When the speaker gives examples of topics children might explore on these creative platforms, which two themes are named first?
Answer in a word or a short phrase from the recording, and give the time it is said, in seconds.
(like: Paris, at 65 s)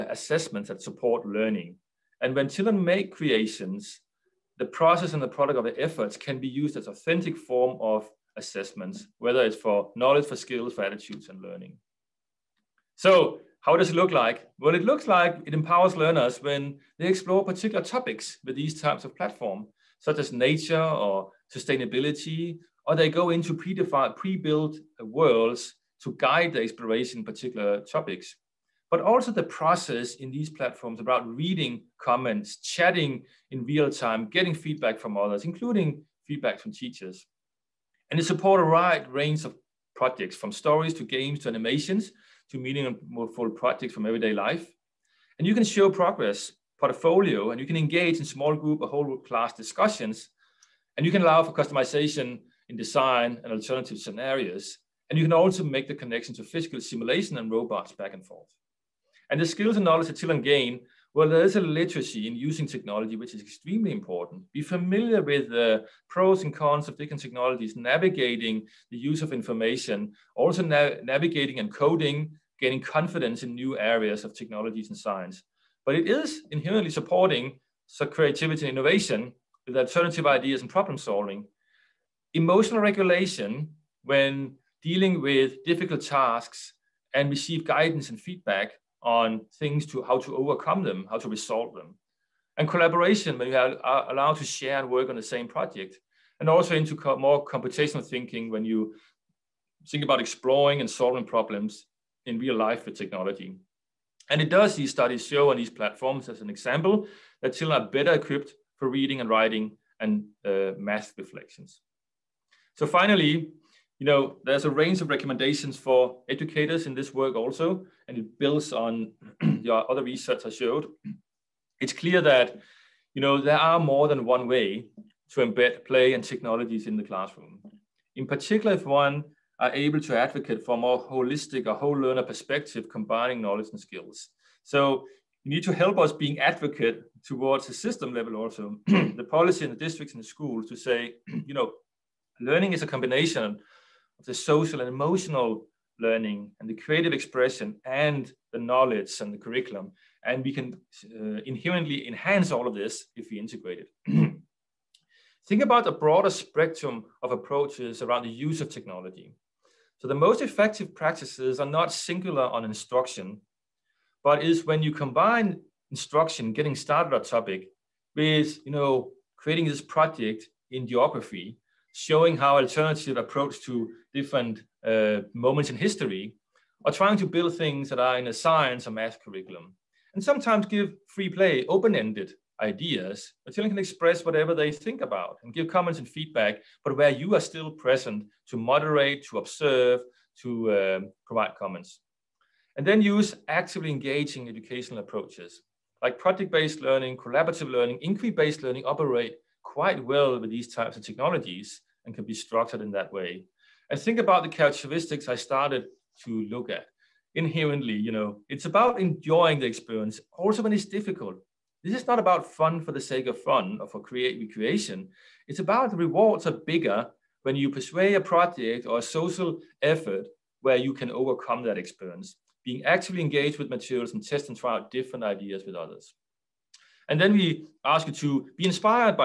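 nature or sustainability, at 20 s.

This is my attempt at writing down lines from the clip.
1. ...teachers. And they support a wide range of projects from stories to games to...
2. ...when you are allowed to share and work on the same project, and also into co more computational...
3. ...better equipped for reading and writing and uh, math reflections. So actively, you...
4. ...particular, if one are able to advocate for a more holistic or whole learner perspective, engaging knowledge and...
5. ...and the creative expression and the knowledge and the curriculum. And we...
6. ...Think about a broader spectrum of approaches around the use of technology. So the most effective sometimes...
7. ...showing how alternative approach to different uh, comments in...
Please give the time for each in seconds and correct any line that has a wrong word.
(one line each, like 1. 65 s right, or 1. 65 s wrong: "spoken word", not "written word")
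1. 36 s right
2. 93 s right
3. 107 s wrong: "finally", not "actively"
4. 128 s wrong: "combining", not "engaging"
5. 146 s right
6. 155 s wrong: "practices", not "sometimes"
7. 171 s wrong: "moments", not "comments".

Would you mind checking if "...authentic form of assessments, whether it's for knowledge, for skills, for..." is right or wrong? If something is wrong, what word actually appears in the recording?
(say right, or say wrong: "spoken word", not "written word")
right.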